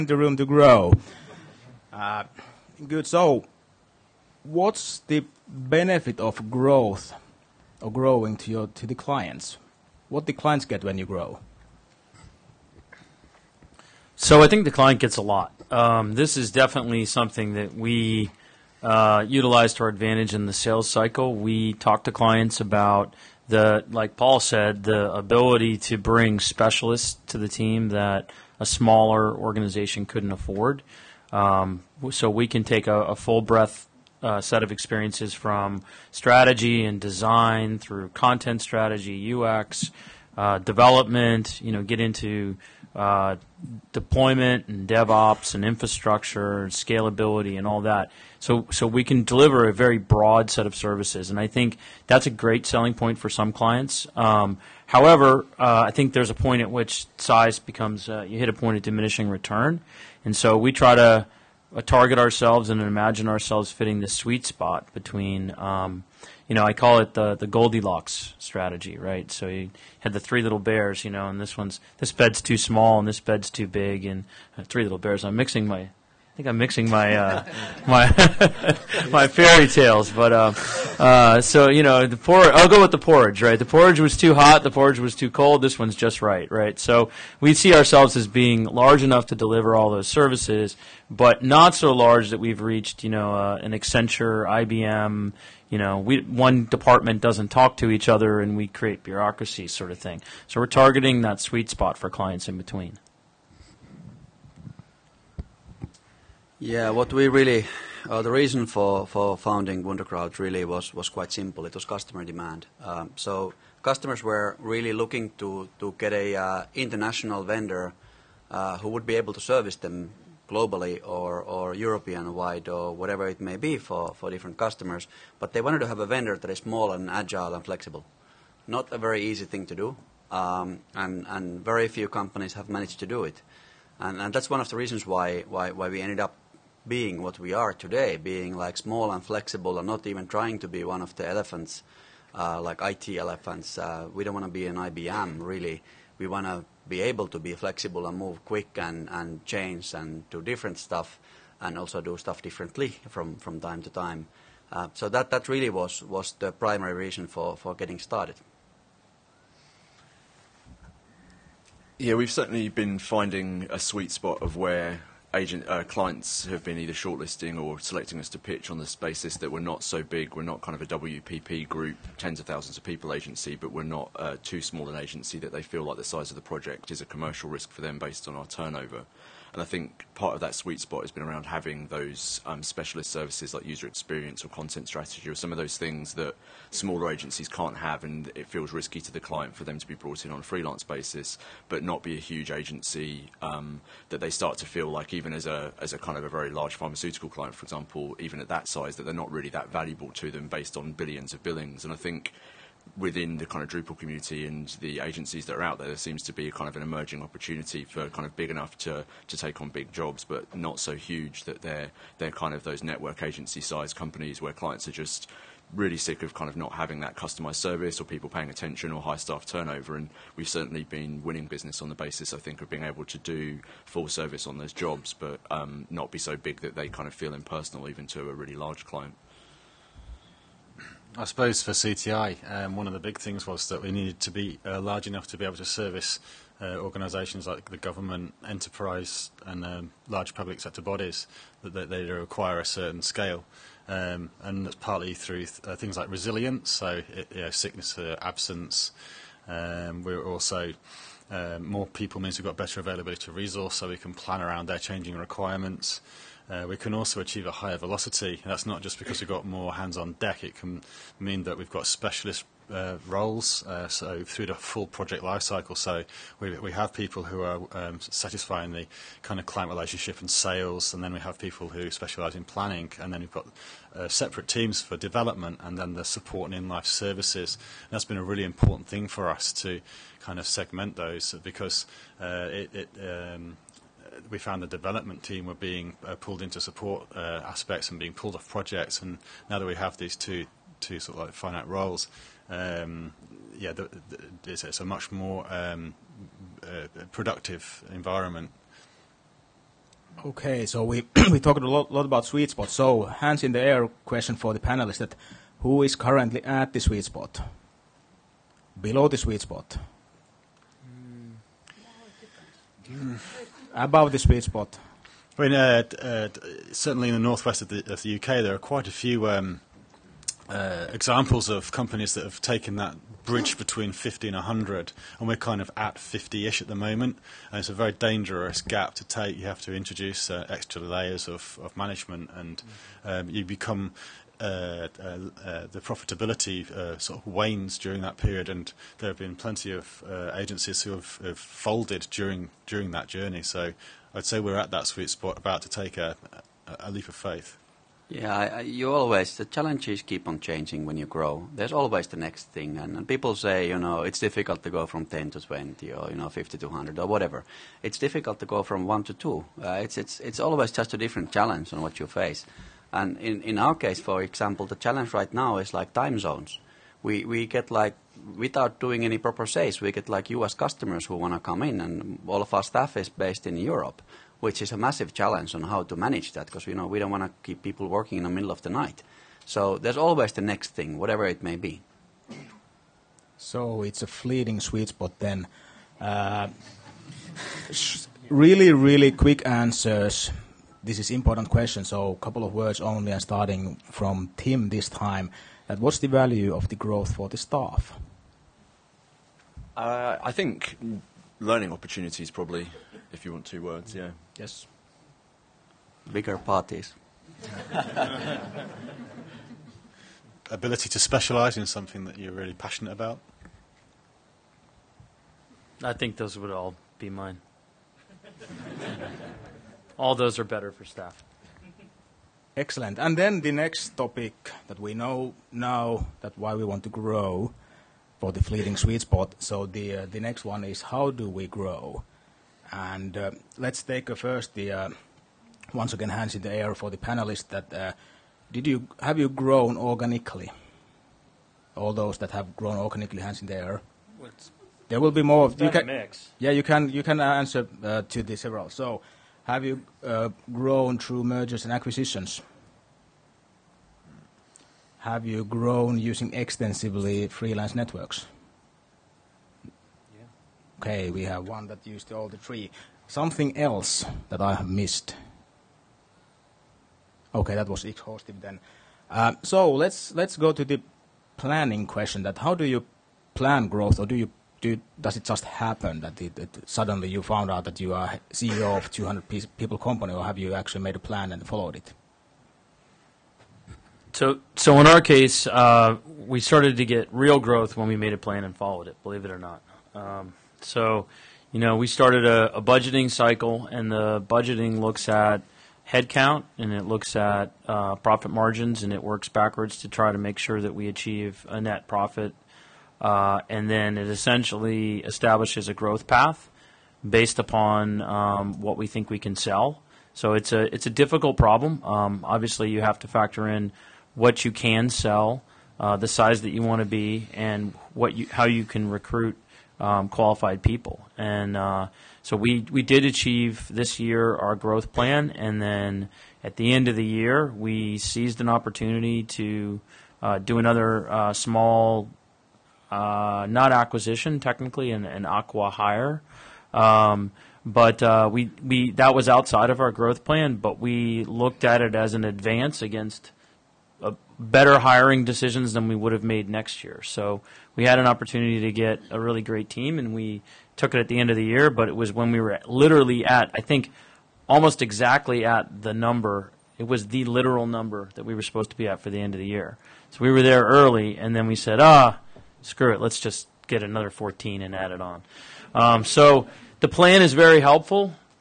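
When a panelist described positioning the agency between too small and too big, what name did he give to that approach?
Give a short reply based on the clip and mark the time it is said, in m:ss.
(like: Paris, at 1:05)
Goldilocks strategy, at 1:07.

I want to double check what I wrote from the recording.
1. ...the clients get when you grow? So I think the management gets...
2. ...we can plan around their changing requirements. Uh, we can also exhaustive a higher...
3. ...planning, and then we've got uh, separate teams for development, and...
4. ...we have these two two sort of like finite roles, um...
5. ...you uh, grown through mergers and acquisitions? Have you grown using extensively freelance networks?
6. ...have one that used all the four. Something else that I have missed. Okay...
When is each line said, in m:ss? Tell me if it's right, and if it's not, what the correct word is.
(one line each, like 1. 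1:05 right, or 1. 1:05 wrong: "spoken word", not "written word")
1. 0:10 wrong: "client", not "management"
2. 4:13 wrong: "achieve", not "exhaustive"
3. 4:32 right
4. 4:49 right
5. 7:29 right
6. 7:41 wrong: "three", not "four".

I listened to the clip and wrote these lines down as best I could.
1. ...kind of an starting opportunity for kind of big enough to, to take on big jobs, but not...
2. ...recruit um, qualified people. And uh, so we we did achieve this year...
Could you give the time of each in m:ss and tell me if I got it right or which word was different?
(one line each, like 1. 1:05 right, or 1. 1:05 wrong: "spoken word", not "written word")
1. 3:26 wrong: "emerging", not "starting"
2. 8:38 right.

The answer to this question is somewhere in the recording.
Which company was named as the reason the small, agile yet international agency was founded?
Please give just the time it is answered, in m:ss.
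1:49.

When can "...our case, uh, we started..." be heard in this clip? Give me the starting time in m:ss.
8:04.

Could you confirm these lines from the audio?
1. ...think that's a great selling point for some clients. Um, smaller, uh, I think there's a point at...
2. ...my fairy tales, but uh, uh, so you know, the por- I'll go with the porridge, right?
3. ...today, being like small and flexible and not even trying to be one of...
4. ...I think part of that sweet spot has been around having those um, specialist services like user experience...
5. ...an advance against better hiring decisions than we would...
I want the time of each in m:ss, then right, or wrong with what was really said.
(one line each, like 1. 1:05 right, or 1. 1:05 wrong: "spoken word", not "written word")
1. 0:51 wrong: "however", not "smaller"
2. 1:19 right
3. 2:17 right
4. 2:59 right
5. 9:02 right.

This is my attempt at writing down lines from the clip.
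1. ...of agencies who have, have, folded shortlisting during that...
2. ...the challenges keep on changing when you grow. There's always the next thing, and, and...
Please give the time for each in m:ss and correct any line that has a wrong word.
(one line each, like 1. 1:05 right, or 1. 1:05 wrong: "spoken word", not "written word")
1. 5:39 wrong: "during", not "shortlisting"
2. 5:49 right.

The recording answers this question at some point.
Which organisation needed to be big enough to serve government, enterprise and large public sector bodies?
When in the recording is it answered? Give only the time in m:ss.
3:51.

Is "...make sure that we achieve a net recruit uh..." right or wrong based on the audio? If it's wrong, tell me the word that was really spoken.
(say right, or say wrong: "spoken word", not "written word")
wrong: "profit", not "recruit".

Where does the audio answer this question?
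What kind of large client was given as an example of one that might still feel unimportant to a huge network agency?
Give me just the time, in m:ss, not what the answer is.
3:16.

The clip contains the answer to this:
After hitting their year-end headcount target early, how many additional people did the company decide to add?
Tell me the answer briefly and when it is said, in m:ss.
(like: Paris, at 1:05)
14, at 9:24.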